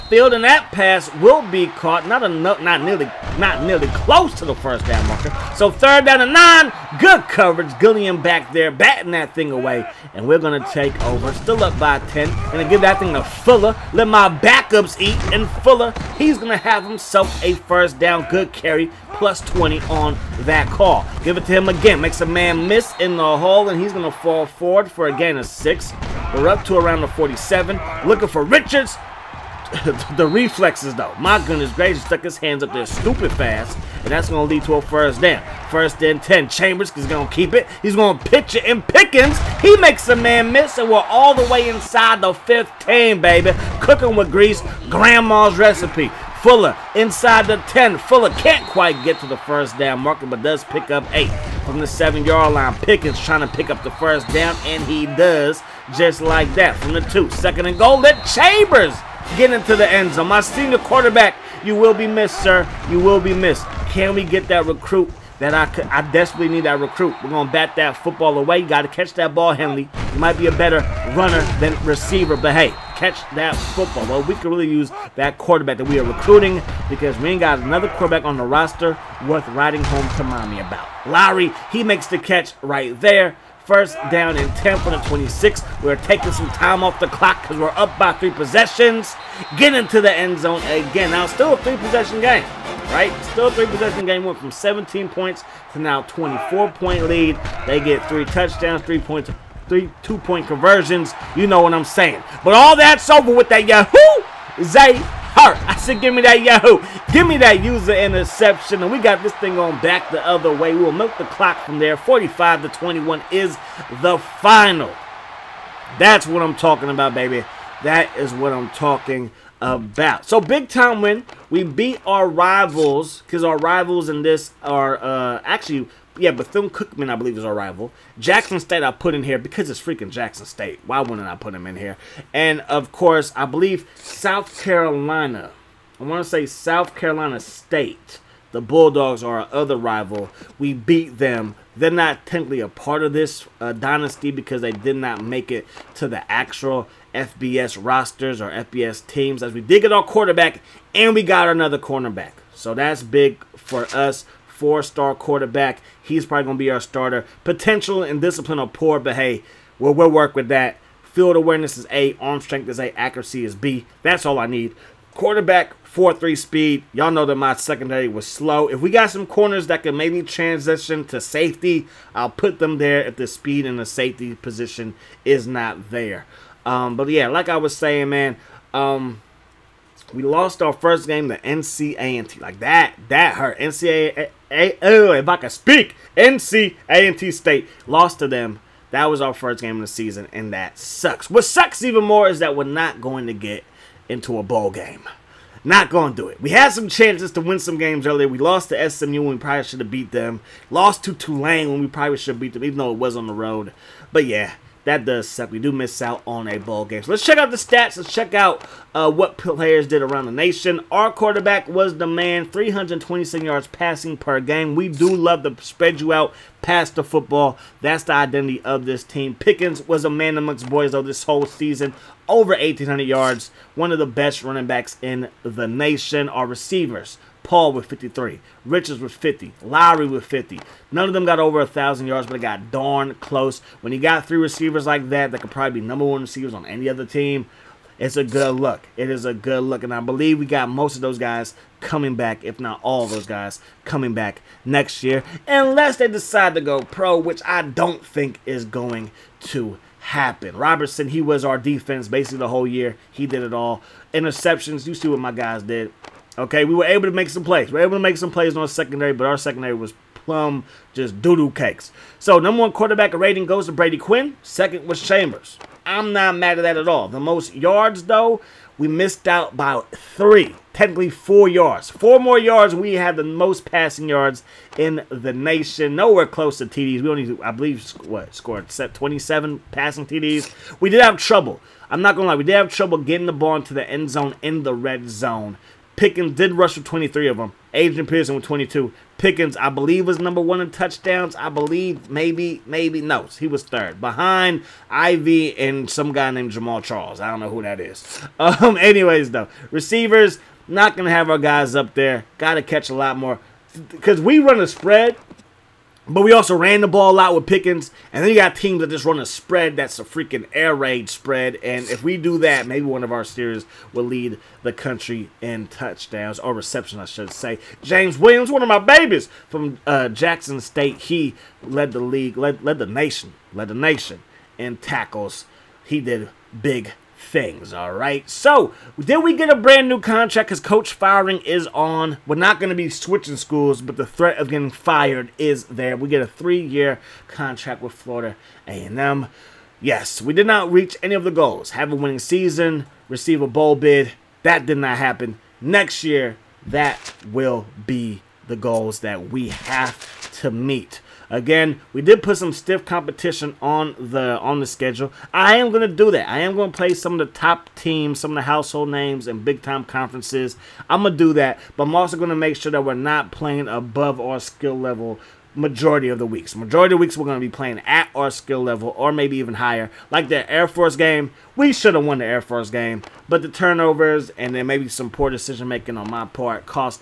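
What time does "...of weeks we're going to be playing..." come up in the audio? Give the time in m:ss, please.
6:06.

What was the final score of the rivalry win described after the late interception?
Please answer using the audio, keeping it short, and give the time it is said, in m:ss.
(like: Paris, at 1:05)
45 to 21, at 1:51.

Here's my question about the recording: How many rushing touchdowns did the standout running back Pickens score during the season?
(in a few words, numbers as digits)
23.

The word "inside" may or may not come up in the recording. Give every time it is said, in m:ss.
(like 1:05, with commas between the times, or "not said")
0:41, 0:46.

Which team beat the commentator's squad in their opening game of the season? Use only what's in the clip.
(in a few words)
NC A&T State.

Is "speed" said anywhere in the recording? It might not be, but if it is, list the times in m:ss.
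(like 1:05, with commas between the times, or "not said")
2:46, 2:53.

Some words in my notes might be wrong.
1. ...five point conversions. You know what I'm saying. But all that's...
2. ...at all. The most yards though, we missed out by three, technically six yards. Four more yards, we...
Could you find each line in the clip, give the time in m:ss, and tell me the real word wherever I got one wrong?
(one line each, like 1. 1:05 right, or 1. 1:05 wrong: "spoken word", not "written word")
1. 1:40 wrong: "two", not "five"
2. 4:26 wrong: "four", not "six".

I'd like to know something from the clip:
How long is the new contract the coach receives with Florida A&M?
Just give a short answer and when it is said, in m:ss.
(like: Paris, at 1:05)
3 years, at 5:36.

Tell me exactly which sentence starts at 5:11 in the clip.
And if we do that, maybe one of our series will lead the country in touchdowns or reception, I should say.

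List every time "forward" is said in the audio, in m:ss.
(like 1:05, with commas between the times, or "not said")
0:24.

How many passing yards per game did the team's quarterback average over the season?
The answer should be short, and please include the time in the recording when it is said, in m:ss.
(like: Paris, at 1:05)
327, at 3:32.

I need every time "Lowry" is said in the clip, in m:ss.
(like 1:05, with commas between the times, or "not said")
1:21, 3:49.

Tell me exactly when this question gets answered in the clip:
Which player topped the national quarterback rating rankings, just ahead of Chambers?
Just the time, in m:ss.
4:23.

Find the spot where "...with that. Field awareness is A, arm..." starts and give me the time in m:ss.
2:40.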